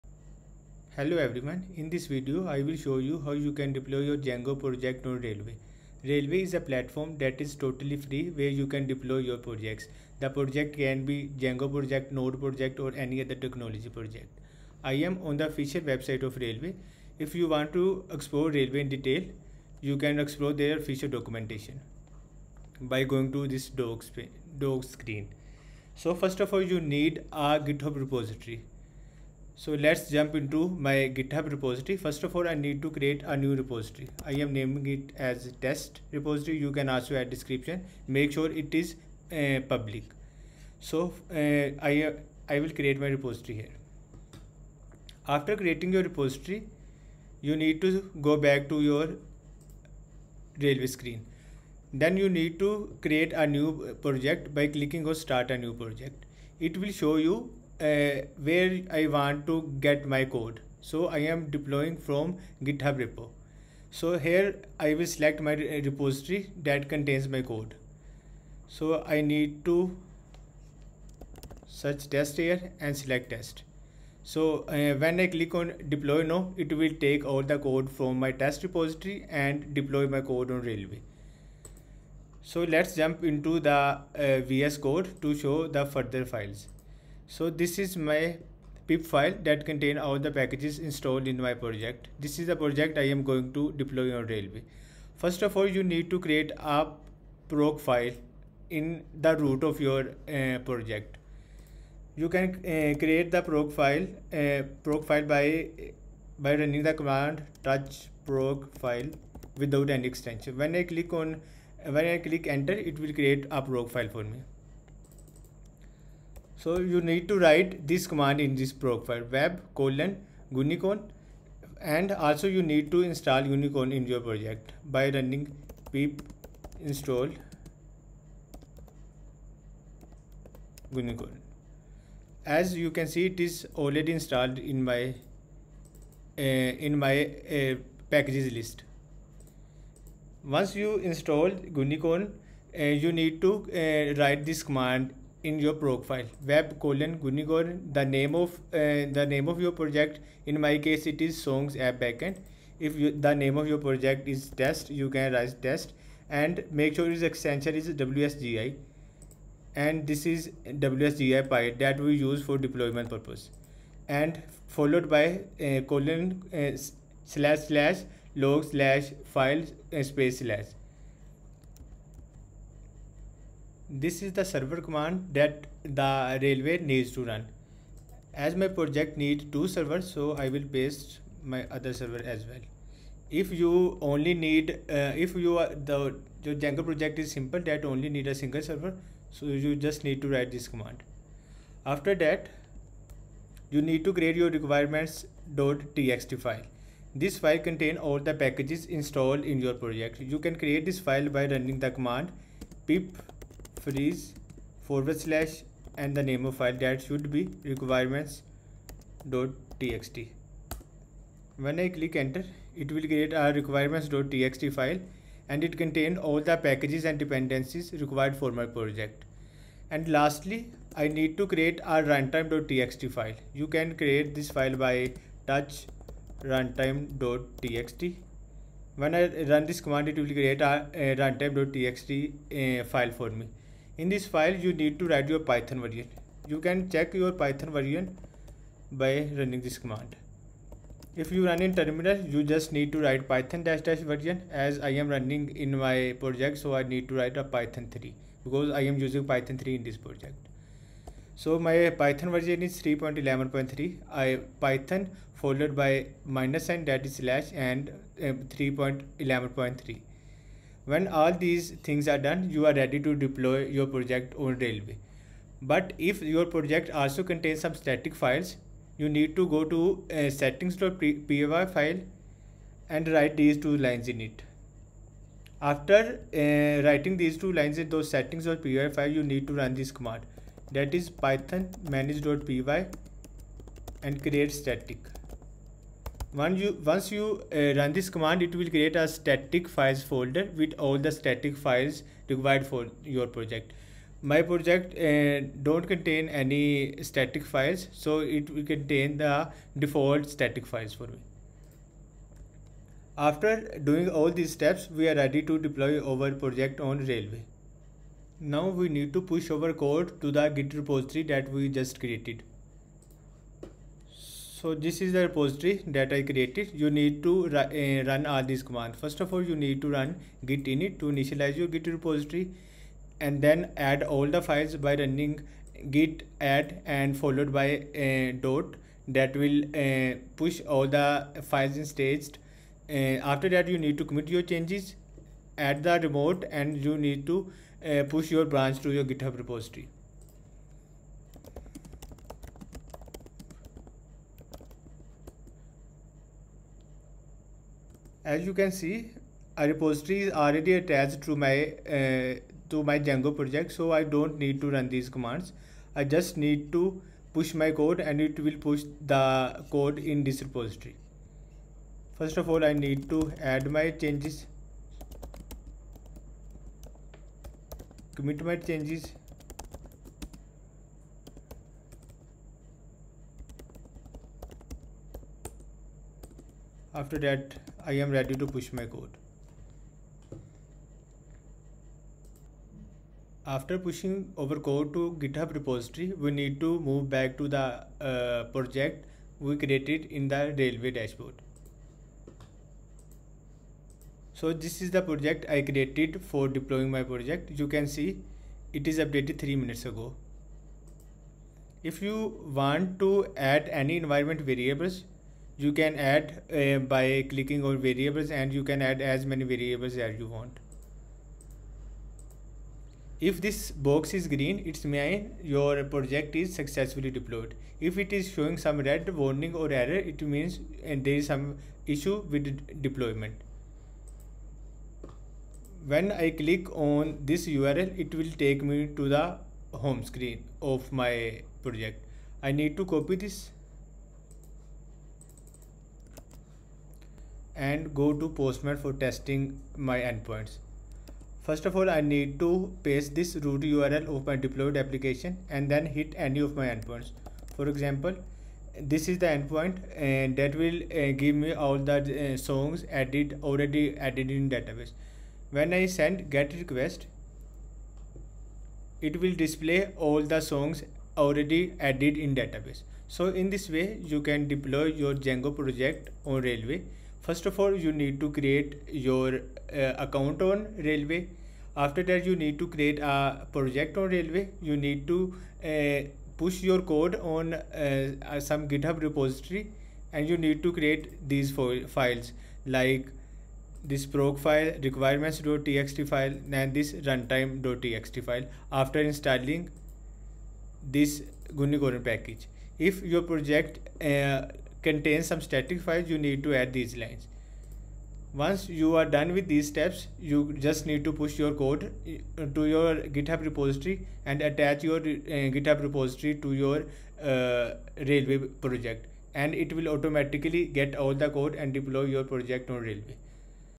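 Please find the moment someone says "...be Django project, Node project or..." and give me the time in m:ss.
0:11.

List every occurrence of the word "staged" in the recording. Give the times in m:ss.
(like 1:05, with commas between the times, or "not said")
5:31.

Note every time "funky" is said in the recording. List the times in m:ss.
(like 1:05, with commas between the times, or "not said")
not said.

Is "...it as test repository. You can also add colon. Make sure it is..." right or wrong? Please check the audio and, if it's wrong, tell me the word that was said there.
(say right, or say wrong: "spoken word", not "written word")
wrong: "description", not "colon".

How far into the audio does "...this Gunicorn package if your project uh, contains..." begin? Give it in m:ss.
8:10.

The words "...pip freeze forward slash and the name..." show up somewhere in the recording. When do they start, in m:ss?
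3:22.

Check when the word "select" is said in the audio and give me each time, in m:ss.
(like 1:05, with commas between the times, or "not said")
1:05, 1:12.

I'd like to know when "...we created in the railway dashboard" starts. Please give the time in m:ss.
6:29.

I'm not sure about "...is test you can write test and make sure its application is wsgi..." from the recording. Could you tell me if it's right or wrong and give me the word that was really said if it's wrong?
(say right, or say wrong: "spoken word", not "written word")
wrong: "extension", not "application".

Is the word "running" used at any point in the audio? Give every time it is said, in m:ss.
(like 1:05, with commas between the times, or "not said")
1:46, 2:05, 3:21, 3:59, 4:05, 5:25.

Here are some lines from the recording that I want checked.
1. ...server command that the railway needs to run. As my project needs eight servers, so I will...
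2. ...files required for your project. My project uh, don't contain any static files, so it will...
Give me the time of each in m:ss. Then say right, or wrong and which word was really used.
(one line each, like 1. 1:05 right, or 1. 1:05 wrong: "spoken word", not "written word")
1. 2:54 wrong: "two", not "eight"
2. 4:51 right.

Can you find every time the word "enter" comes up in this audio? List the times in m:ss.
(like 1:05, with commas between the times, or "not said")
1:52, 3:32.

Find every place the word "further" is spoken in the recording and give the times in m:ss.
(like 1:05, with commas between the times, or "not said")
1:25.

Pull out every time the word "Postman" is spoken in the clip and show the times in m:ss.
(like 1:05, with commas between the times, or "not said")
7:18.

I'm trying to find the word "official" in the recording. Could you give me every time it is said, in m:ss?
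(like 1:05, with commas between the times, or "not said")
0:15, 0:20.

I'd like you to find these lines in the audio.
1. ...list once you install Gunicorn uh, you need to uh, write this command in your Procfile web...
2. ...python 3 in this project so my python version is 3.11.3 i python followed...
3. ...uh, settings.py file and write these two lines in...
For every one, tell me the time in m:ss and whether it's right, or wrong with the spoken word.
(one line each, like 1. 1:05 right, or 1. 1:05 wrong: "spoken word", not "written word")
1. 2:18 right
2. 4:09 right
3. 4:30 right.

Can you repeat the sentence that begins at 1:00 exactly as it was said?
So I am deploying from GitHub repo.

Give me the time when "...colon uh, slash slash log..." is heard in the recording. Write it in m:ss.
2:45.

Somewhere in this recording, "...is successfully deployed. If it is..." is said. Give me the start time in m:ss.
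6:56.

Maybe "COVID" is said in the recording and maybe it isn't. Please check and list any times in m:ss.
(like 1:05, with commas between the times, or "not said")
not said.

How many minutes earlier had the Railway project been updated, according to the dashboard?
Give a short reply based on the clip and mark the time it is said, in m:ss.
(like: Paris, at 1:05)
3, at 6:39.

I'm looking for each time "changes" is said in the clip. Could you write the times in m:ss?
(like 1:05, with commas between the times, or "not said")
5:34, 6:04, 6:08.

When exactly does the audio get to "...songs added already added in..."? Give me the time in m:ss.
7:32.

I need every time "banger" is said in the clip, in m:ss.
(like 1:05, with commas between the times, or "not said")
not said.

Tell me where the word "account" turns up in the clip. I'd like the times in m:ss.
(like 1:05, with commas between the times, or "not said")
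7:50.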